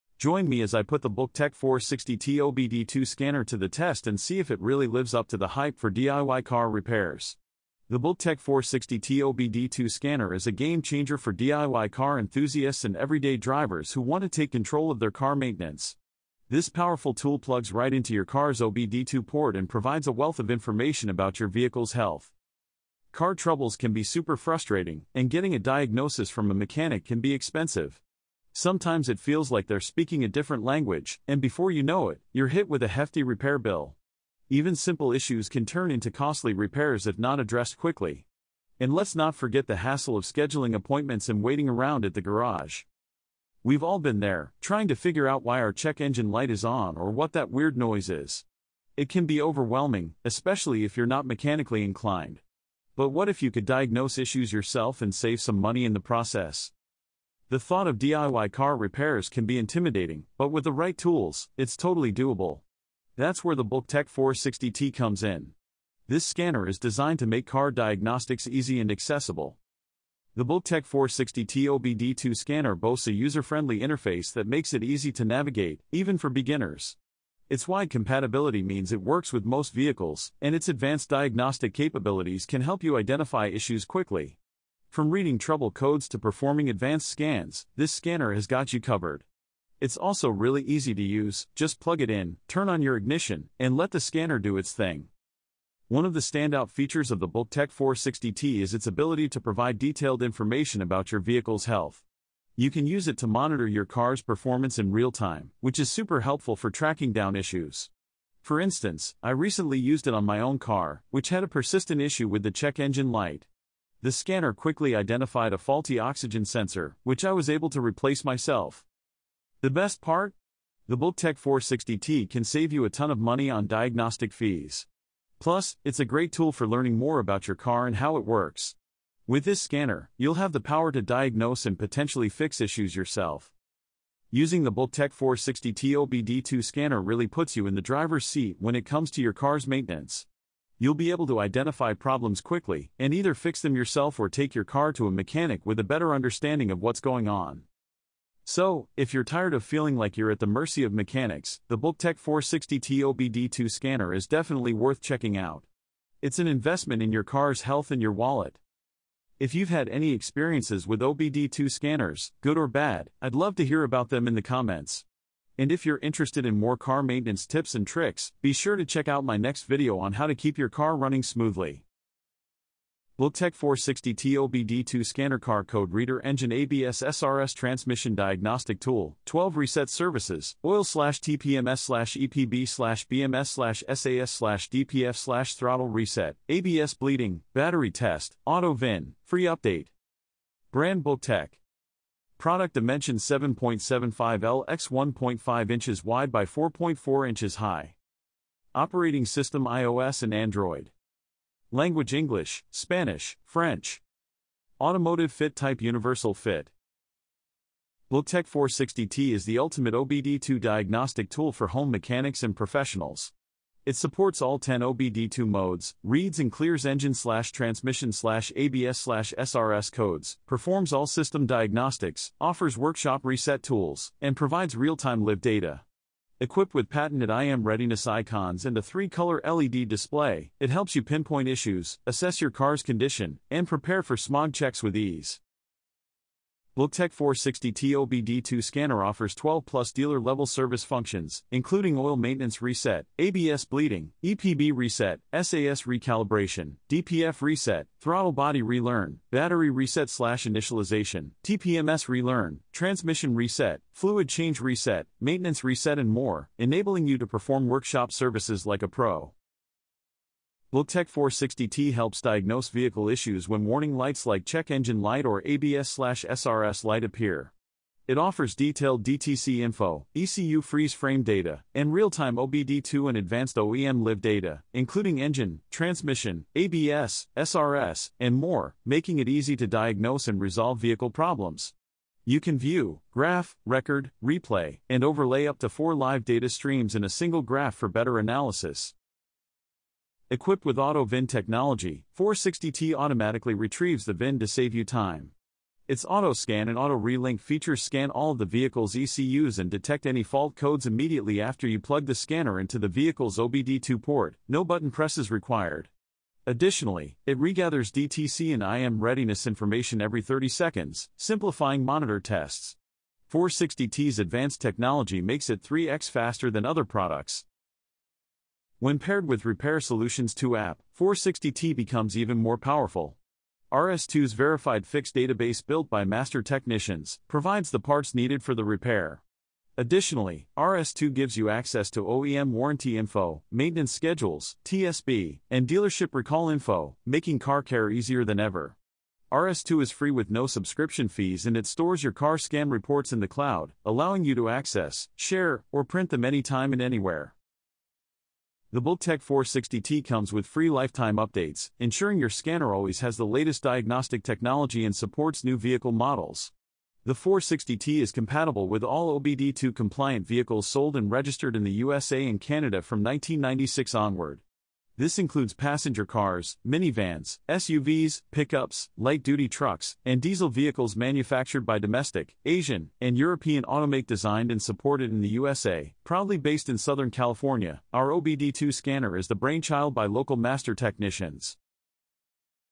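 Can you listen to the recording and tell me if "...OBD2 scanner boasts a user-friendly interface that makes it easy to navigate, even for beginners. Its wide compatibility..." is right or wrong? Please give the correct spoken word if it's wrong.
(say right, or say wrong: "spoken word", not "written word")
right.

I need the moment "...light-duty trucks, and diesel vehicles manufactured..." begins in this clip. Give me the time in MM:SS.
06:08.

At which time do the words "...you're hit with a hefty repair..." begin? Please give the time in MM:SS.
00:32.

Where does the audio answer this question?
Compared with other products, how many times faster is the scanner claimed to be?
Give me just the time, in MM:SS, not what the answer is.
05:15.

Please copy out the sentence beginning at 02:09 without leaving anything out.
With this scanner, you'll have the power to diagnose and potentially fix issues yourself.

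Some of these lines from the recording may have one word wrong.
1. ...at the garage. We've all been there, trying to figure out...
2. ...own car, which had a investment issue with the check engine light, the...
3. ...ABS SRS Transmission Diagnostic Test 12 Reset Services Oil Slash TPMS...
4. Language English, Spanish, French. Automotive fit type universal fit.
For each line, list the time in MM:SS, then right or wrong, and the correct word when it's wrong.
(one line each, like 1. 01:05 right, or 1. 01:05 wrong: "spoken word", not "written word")
1. 00:42 right
2. 01:50 wrong: "persistent", not "investment"
3. 02:56 wrong: "Tool", not "Test"
4. 03:21 right.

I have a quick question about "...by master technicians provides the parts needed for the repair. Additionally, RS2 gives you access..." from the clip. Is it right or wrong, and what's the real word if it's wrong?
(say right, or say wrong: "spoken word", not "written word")
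right.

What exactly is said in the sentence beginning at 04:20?
BLCKTEC 460T helps diagnose vehicle issues when warning lights like check engine light or ABS/SRS light appear.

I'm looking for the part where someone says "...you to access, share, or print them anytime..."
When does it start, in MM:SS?
05:44.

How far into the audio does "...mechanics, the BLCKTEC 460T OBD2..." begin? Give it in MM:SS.
02:30.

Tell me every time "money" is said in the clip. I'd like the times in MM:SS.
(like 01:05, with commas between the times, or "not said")
00:55, 02:03.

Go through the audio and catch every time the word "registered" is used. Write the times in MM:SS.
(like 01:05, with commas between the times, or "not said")
06:01.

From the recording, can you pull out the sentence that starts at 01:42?
You can use it to monitor your car's performance in real time, which is super helpful for tracking down issues.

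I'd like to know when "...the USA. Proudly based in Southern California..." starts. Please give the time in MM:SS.
06:15.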